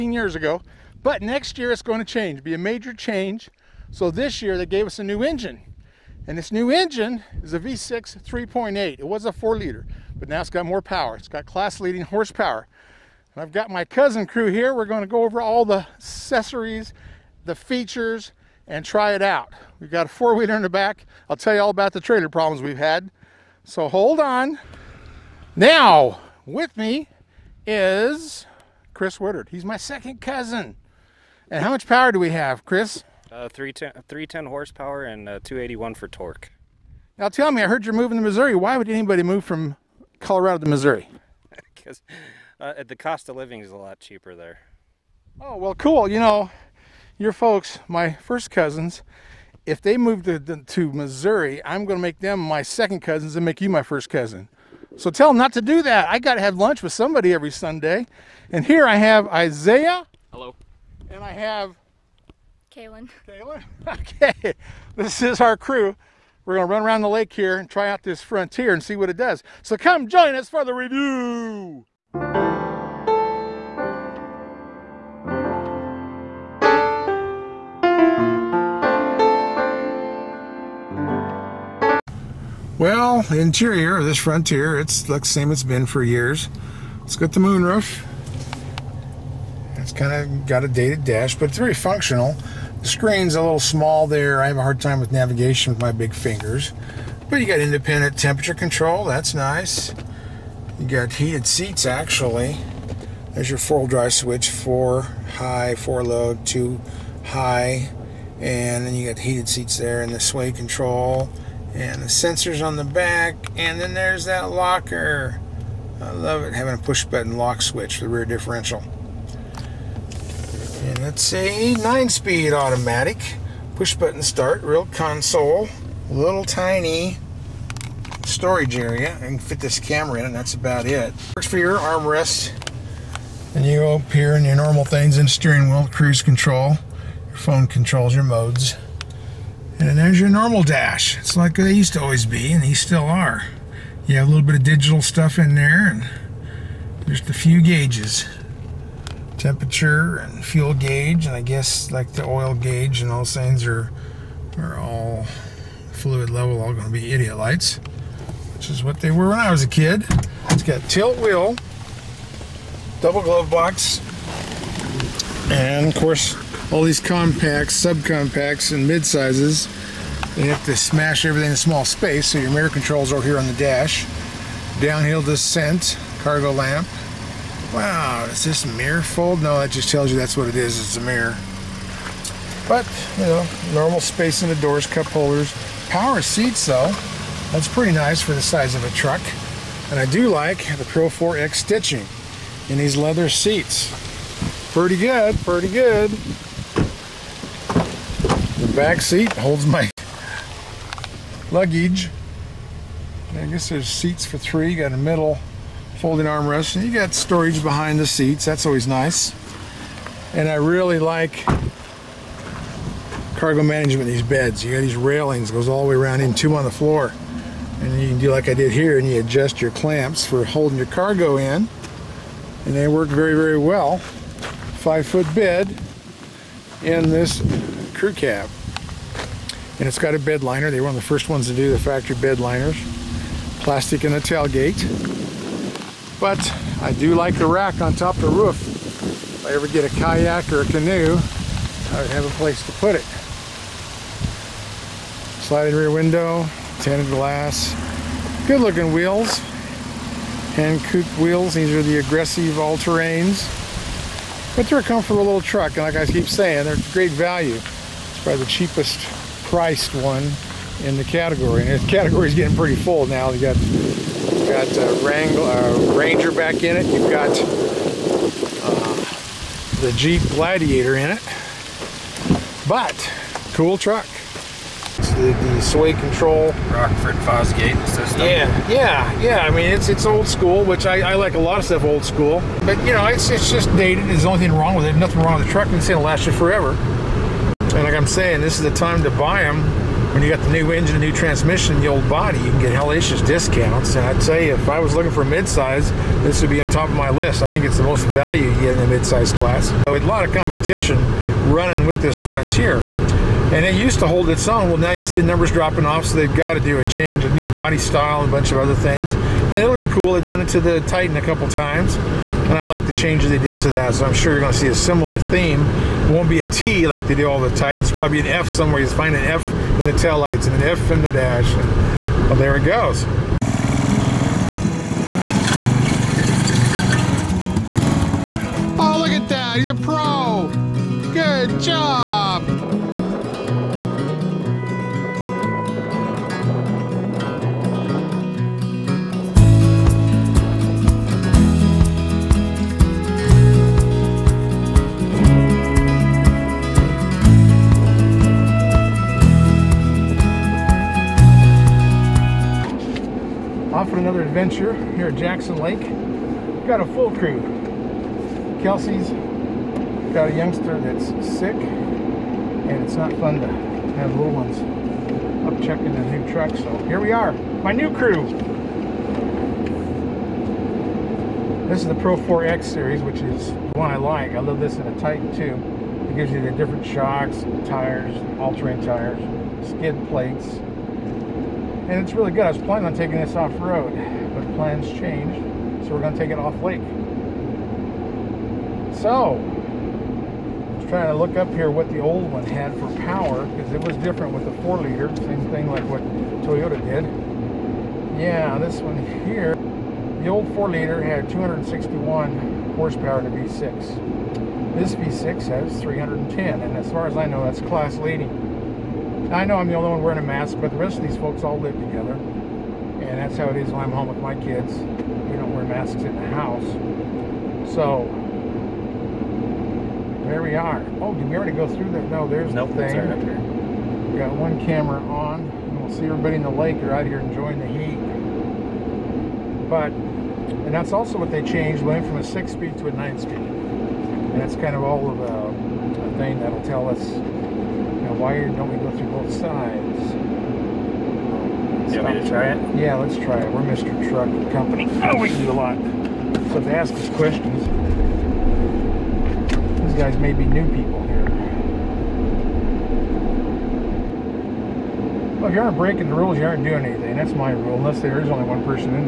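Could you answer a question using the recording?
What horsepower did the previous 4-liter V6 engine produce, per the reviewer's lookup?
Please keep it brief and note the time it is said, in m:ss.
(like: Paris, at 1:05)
261, at 6:41.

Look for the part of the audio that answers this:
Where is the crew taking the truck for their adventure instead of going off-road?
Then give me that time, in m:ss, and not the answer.
5:55.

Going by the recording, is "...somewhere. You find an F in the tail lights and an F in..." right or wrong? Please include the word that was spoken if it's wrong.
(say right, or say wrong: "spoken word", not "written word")
right.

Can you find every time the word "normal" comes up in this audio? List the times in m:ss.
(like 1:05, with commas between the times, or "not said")
2:14, 2:20, 3:03.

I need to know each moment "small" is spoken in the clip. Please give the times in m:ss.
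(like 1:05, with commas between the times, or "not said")
1:33, 2:51.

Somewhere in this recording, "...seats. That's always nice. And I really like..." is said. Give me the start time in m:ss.
3:28.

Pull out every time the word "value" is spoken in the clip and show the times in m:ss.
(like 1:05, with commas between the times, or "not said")
4:17, 4:58.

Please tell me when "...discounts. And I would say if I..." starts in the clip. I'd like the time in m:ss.
4:53.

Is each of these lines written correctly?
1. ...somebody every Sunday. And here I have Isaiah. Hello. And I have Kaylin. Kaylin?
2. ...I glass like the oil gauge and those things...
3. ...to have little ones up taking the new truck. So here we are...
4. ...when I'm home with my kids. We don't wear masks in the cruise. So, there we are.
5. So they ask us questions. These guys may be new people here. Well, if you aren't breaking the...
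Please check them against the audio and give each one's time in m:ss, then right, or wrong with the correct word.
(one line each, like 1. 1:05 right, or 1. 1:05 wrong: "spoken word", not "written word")
1. 0:56 right
2. 2:31 wrong: "guess", not "glass"
3. 6:03 wrong: "checking", not "taking"
4. 6:53 wrong: "house", not "cruise"
5. 7:26 right.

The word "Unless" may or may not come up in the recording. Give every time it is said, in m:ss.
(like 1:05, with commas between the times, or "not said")
7:37.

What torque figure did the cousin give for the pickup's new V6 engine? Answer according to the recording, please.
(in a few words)
281.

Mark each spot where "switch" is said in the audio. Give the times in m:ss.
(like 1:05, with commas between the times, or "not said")
1:44, 1:57.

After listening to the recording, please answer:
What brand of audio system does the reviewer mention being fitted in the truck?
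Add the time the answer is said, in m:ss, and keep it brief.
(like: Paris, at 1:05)
Rockford Fosgate, at 4:36.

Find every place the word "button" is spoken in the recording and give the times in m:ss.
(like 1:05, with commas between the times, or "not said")
1:57, 2:03.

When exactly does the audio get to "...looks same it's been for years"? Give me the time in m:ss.
1:25.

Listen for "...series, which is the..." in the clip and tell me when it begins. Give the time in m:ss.
6:12.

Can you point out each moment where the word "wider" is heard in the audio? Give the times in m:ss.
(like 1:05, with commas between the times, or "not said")
not said.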